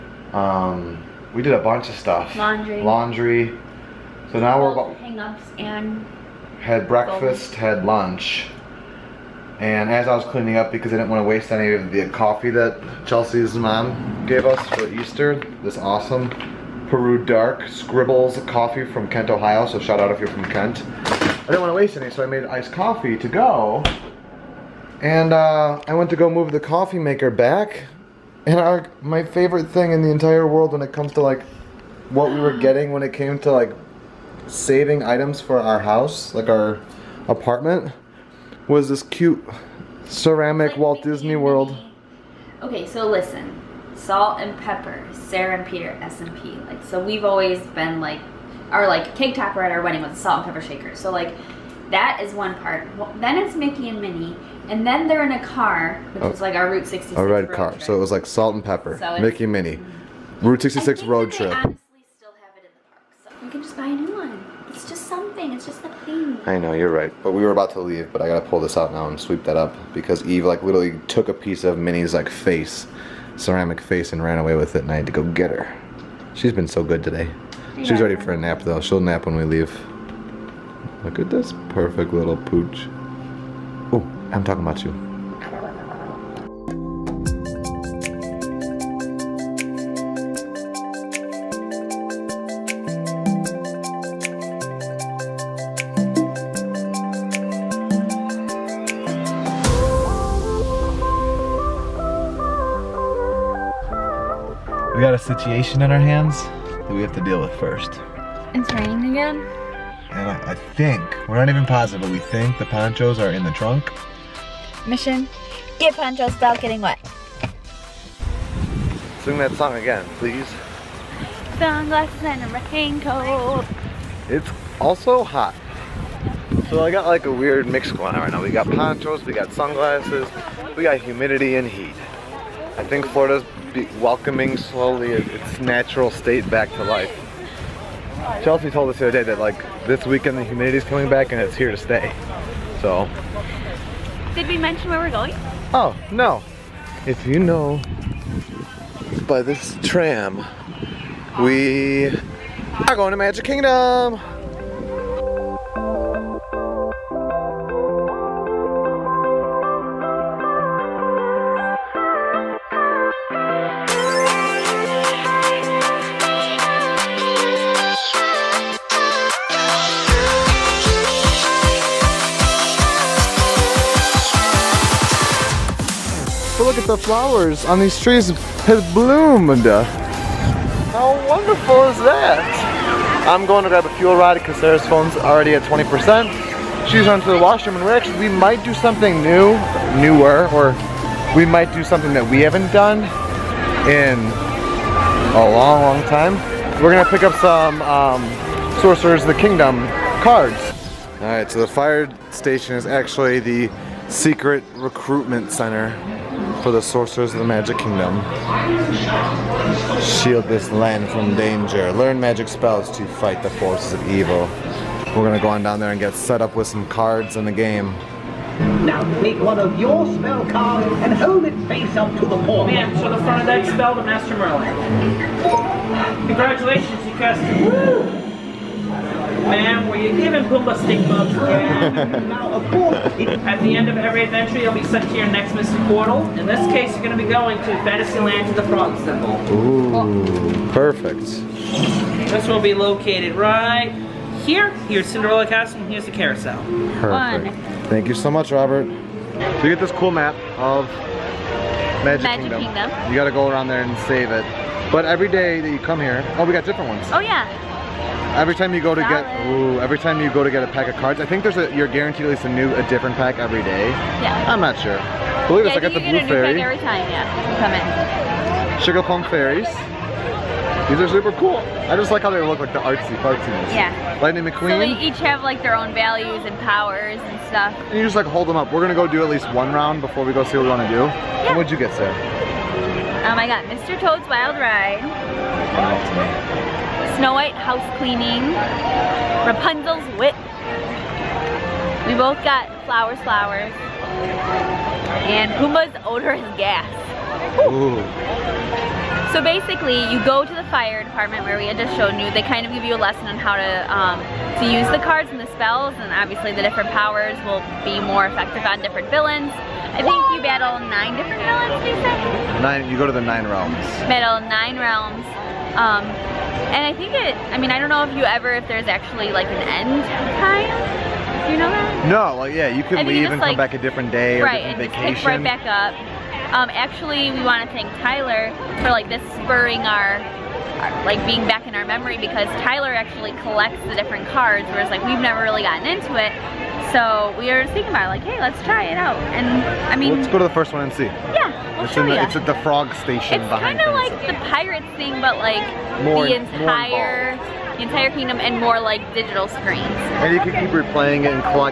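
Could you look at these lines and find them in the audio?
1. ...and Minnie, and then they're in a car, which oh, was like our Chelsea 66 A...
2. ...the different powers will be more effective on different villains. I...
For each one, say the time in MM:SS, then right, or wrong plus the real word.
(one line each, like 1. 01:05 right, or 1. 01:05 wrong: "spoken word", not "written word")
1. 00:53 wrong: "Route", not "Chelsea"
2. 05:06 right.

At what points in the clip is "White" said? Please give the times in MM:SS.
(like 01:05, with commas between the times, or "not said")
04:47.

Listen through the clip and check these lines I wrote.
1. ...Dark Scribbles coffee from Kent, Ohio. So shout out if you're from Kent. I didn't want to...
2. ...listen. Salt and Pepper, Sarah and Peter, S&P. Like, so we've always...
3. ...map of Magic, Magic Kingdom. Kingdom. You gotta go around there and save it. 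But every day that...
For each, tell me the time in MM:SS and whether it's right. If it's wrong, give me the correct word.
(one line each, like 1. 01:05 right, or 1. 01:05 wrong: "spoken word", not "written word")
1. 00:17 right
2. 00:43 right
3. 04:10 right.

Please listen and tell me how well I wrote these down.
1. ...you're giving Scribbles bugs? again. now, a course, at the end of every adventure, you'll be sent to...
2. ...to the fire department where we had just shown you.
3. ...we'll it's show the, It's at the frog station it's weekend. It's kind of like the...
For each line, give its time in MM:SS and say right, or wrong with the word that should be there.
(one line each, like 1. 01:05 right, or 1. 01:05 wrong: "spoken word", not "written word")
1. 03:50 wrong: "Pumbaa", not "Scribbles"
2. 05:00 right
3. 05:41 wrong: "behind", not "weekend".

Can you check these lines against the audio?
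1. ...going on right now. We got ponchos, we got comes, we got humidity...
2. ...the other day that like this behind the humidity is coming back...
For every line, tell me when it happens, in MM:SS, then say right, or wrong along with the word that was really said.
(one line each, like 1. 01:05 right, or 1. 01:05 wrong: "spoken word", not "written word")
1. 02:07 wrong: "sunglasses", not "comes"
2. 02:18 wrong: "weekend", not "behind".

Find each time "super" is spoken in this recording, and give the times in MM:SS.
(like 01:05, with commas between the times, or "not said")
04:31.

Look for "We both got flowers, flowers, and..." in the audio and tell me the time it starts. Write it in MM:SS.
04:52.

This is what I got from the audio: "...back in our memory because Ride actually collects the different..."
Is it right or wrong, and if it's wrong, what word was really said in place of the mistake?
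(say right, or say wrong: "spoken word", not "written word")
wrong: "Tyler", not "Ride".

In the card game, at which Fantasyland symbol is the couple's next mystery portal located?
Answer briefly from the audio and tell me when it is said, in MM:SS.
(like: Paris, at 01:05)
Frog Symbol, at 03:58.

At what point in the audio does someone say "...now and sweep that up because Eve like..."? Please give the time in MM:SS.
01:08.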